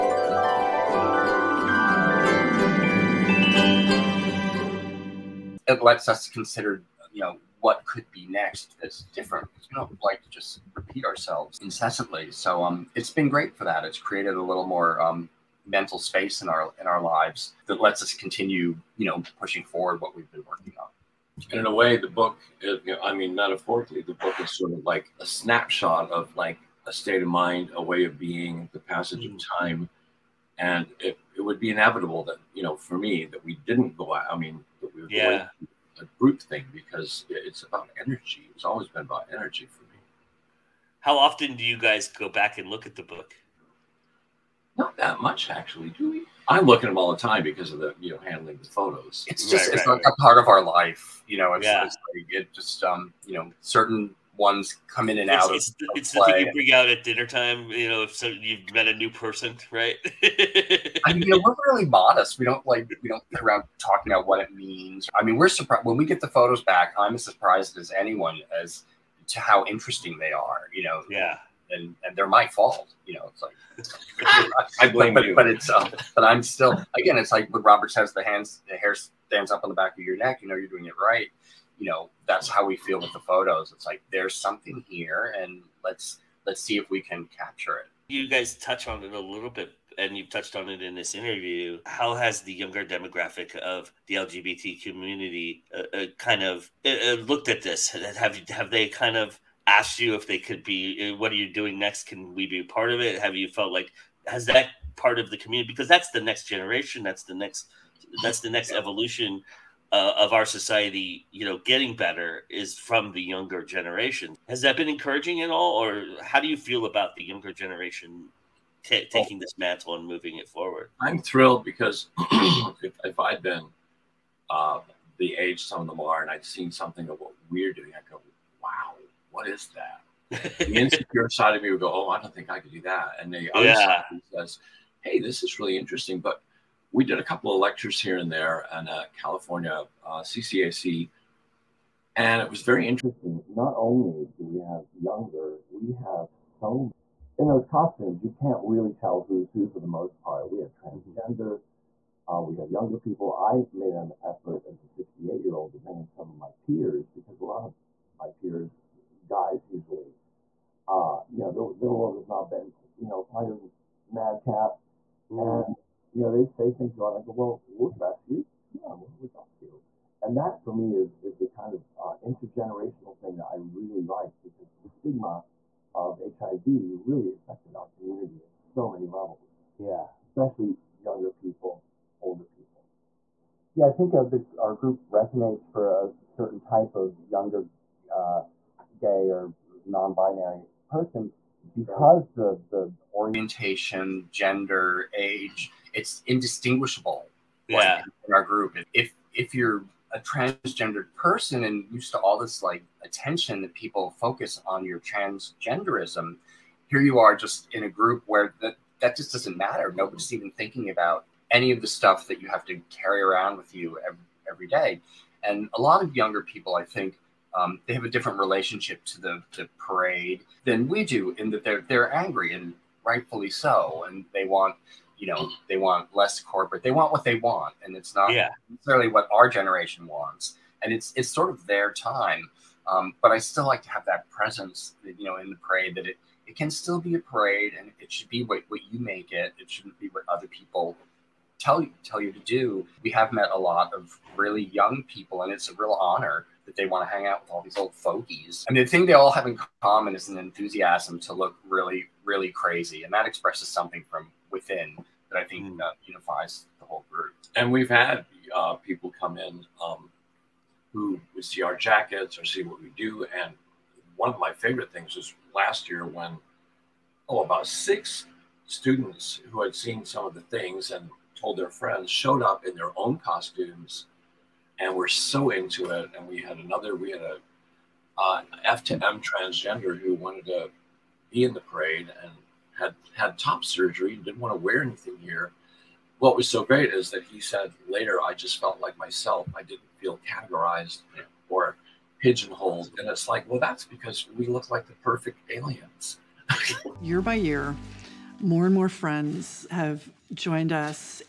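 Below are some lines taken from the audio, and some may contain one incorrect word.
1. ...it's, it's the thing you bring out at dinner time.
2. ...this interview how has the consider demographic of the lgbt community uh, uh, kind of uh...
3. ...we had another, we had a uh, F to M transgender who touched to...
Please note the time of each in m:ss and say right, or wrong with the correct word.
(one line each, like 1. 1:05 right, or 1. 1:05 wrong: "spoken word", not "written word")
1. 0:55 right
2. 1:30 wrong: "younger", not "consider"
3. 4:36 wrong: "wanted", not "touched".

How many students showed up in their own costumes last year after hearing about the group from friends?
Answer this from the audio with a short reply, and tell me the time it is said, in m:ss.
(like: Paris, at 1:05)
6, at 4:27.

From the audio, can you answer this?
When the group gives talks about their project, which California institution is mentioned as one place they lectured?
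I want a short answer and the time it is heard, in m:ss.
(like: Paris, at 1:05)
CCAC, at 2:20.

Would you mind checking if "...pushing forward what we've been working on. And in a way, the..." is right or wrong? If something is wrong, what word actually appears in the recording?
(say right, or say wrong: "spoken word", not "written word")
right.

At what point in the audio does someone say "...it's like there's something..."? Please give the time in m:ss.
1:23.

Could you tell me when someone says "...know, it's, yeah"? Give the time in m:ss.
0:51.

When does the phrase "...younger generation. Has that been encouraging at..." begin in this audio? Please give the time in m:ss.
1:53.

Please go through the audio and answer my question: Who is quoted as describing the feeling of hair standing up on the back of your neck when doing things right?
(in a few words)
Robert.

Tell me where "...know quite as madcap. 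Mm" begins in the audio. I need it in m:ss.
2:43.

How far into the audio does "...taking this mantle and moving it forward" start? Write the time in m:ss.
1:59.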